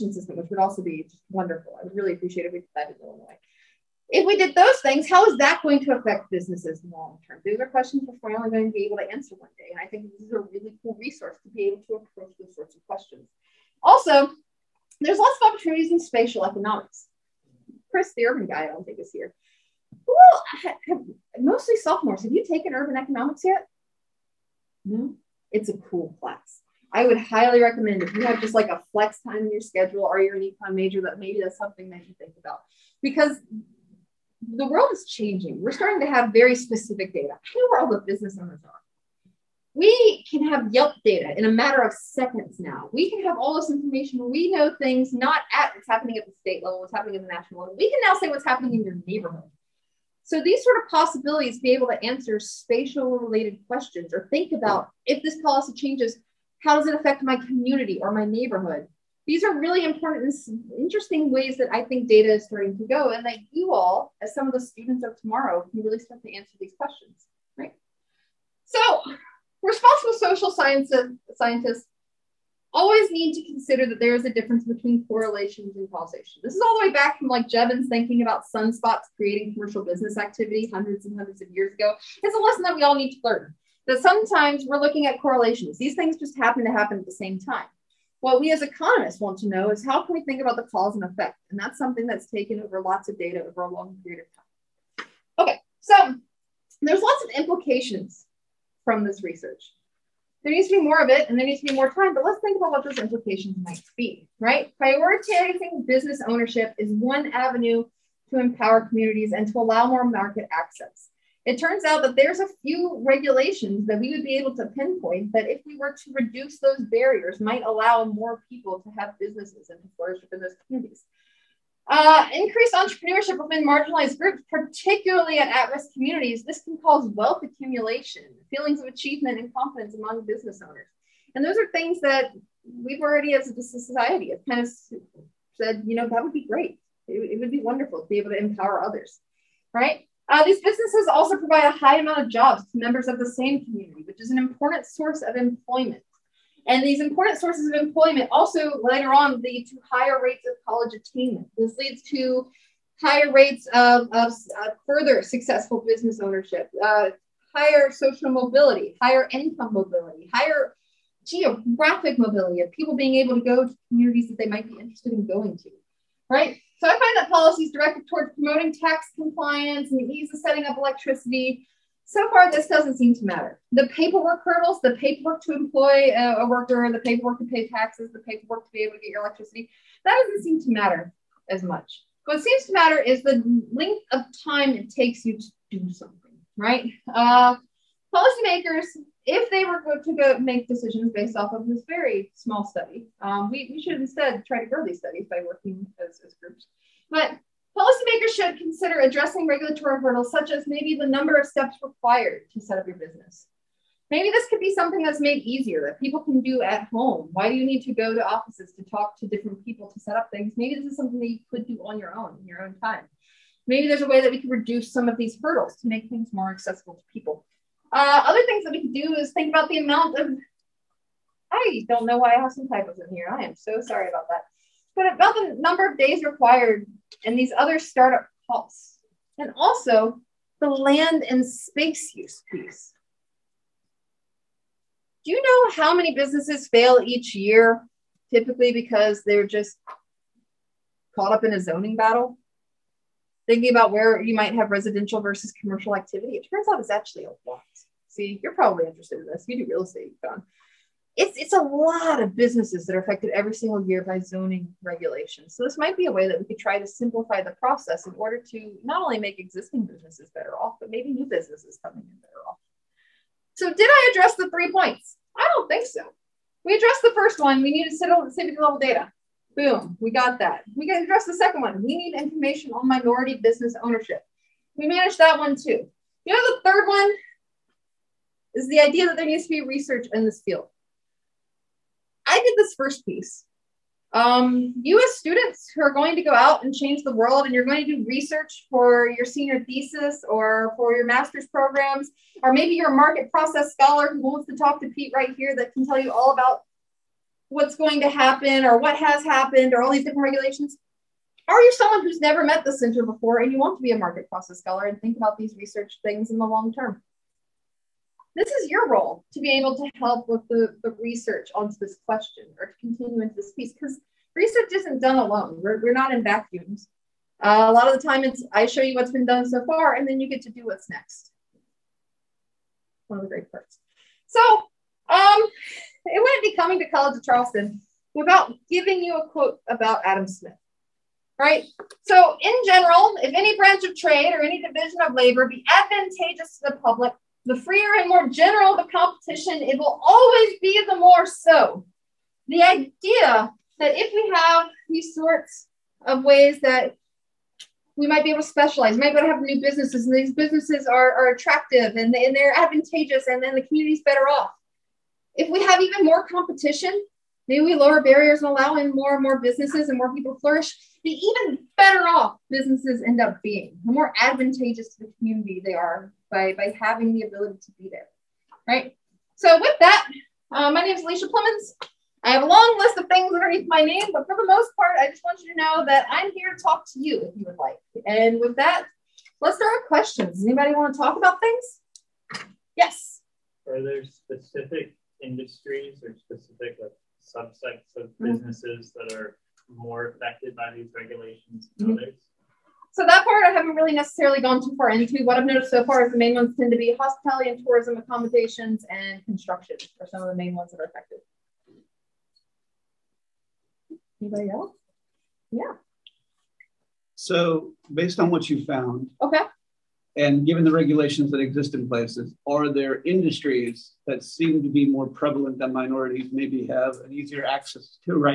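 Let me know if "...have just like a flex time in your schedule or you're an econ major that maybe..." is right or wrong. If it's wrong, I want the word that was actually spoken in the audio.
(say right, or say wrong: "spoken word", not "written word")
right.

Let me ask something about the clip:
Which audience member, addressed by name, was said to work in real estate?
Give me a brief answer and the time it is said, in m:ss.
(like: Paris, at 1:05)
John, at 4:10.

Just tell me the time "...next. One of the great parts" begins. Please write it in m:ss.
5:20.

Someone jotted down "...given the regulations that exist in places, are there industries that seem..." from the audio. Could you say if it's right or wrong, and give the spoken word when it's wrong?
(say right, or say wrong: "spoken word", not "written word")
right.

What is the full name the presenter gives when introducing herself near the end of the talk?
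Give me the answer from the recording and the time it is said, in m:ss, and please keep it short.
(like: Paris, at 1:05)
Alicia Plemmons, at 6:11.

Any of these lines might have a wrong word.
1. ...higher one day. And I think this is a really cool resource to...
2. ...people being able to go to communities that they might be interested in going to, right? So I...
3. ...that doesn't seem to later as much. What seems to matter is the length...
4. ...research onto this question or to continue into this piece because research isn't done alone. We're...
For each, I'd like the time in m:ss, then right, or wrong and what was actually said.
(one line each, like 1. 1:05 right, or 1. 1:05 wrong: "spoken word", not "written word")
1. 0:09 wrong: "answer", not "higher"
2. 2:42 right
3. 3:00 wrong: "matter", not "later"
4. 5:10 right.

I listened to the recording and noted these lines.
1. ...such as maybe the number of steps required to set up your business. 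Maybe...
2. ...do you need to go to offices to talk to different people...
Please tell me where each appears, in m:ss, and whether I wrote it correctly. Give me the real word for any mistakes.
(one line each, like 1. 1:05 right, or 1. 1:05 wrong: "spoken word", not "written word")
1. 3:20 right
2. 3:27 right.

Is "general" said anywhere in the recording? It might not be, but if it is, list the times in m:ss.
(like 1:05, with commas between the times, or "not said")
5:32, 5:38.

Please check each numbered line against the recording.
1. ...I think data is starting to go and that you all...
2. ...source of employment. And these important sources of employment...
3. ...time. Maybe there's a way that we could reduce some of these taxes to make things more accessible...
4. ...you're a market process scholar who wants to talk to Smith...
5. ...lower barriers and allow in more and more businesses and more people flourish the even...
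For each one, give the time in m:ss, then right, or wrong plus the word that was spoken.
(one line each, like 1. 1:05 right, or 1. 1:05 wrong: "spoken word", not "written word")
1. 1:01 right
2. 2:24 right
3. 3:32 wrong: "hurdles", not "taxes"
4. 4:52 wrong: "Pete", not "Smith"
5. 5:57 right.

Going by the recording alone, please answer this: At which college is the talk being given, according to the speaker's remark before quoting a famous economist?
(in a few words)
College of Charleston.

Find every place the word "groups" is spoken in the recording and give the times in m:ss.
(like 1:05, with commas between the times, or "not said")
2:04, 3:16.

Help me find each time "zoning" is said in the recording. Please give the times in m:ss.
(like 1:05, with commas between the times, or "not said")
4:01, 4:14.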